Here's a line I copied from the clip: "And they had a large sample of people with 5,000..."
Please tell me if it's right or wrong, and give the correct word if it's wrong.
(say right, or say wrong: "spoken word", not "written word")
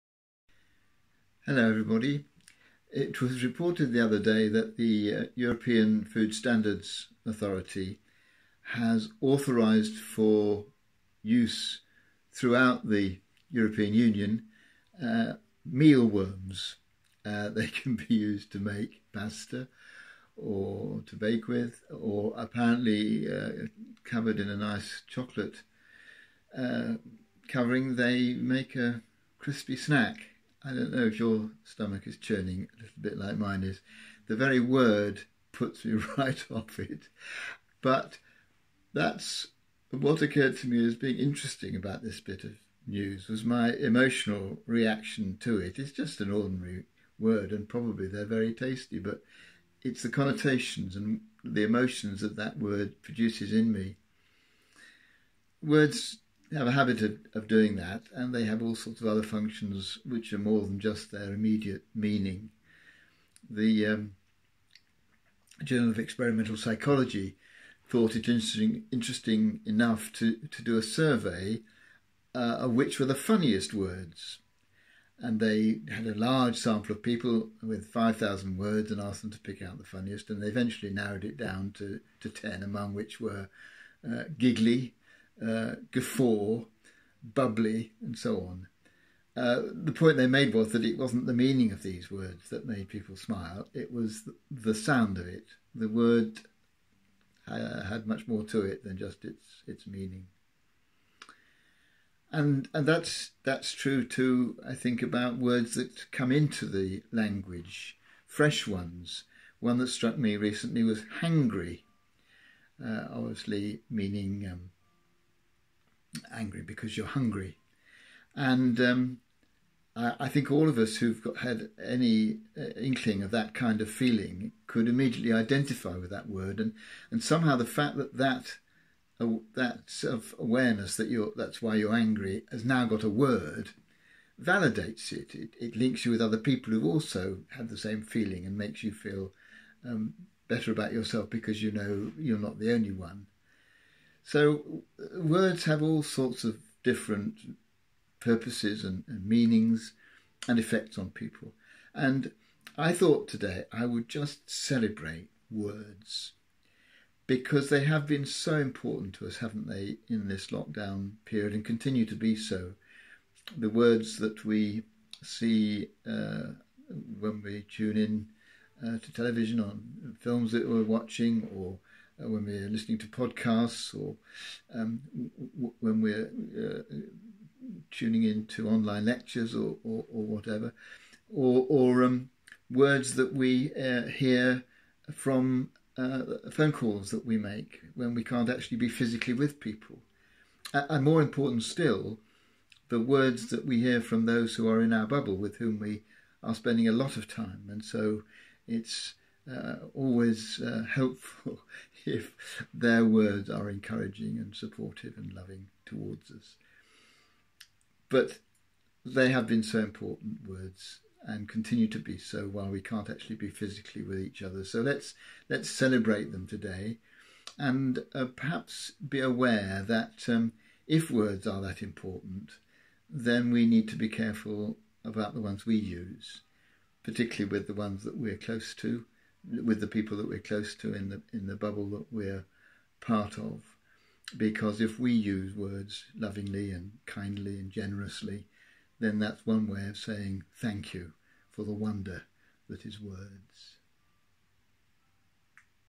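right.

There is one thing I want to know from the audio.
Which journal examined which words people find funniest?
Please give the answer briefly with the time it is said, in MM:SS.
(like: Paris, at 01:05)
Journal of Experimental Psychology, at 01:05.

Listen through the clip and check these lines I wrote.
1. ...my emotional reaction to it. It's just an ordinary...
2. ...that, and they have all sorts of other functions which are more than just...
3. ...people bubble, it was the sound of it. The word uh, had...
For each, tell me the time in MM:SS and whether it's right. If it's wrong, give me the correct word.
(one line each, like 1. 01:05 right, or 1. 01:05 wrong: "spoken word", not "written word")
1. 00:43 right
2. 00:57 right
3. 01:32 wrong: "smile", not "bubble".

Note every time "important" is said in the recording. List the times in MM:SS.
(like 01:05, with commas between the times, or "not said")
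02:38, 03:11, 03:29, 03:41.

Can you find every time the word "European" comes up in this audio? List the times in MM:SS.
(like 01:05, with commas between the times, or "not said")
00:05, 00:13.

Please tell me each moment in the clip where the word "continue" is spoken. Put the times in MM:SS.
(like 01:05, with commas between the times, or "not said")
02:41, 03:31.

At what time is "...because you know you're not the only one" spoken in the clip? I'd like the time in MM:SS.
02:21.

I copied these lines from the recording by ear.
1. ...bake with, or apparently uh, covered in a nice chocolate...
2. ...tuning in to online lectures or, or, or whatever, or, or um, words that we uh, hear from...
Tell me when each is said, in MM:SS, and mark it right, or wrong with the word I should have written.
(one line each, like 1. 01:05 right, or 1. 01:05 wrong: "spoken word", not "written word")
1. 00:21 right
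2. 02:57 right.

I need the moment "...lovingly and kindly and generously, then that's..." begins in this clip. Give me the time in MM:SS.
03:56.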